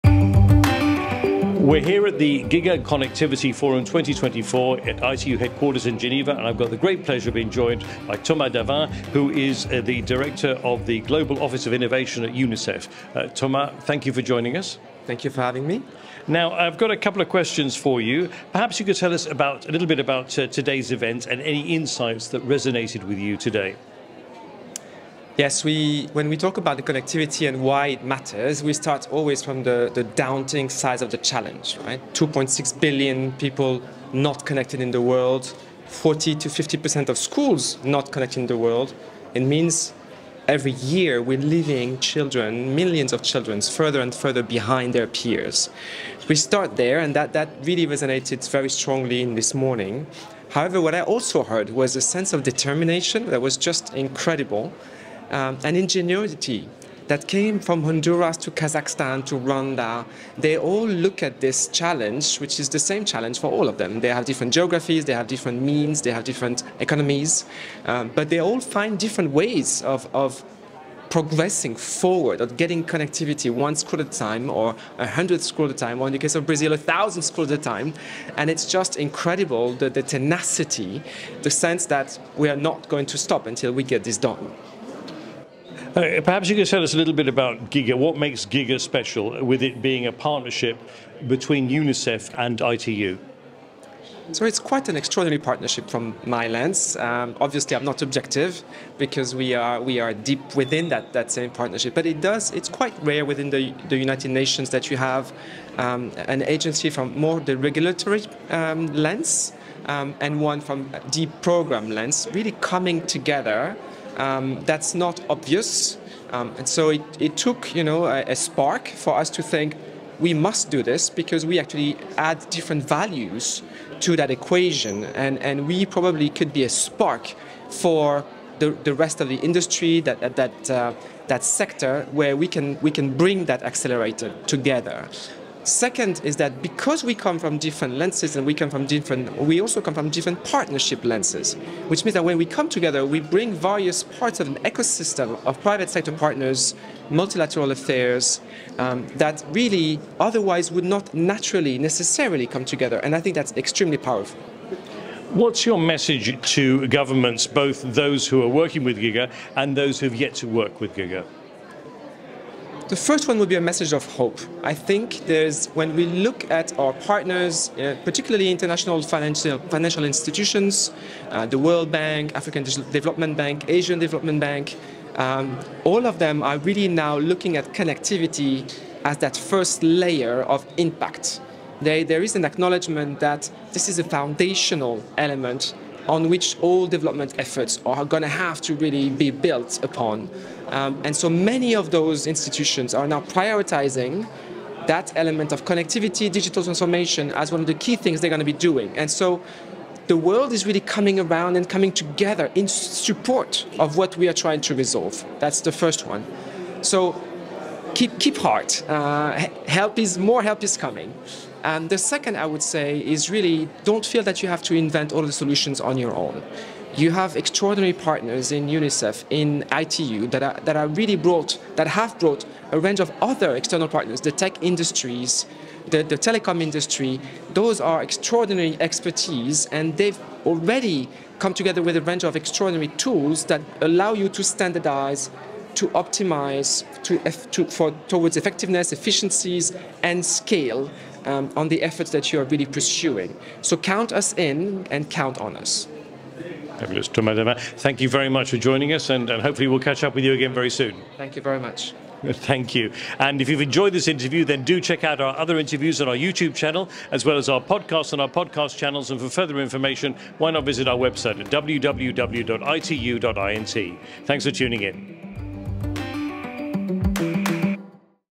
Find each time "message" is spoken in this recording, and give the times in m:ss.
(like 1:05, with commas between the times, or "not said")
2:35, 2:43.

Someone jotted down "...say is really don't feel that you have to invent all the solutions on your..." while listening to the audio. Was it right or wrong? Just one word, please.
right.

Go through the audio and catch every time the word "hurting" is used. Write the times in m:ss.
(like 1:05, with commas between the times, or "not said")
not said.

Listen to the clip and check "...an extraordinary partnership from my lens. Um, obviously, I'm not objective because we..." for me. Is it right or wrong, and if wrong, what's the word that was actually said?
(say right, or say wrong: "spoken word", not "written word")
right.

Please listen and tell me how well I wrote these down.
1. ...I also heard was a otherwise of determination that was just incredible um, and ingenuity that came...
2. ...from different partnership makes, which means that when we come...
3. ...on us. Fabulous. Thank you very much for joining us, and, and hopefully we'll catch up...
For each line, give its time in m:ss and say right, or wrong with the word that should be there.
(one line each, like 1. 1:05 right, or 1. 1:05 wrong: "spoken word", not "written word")
1. 0:50 wrong: "sense", not "otherwise"
2. 2:19 wrong: "lenses", not "makes"
3. 4:05 right.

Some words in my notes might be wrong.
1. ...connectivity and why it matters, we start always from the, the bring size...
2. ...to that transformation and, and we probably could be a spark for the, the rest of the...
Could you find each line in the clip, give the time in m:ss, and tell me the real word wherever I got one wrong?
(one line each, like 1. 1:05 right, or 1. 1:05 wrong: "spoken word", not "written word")
1. 0:26 wrong: "daunting", not "bring"
2. 2:04 wrong: "equation", not "transformation".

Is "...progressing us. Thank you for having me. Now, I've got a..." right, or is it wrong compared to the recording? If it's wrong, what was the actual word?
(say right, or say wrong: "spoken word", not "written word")
wrong: "joining", not "progressing".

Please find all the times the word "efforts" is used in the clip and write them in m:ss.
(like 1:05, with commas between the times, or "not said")
3:07, 4:01.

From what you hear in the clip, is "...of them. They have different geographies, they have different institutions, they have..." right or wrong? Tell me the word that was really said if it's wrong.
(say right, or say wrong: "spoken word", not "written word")
wrong: "means", not "institutions".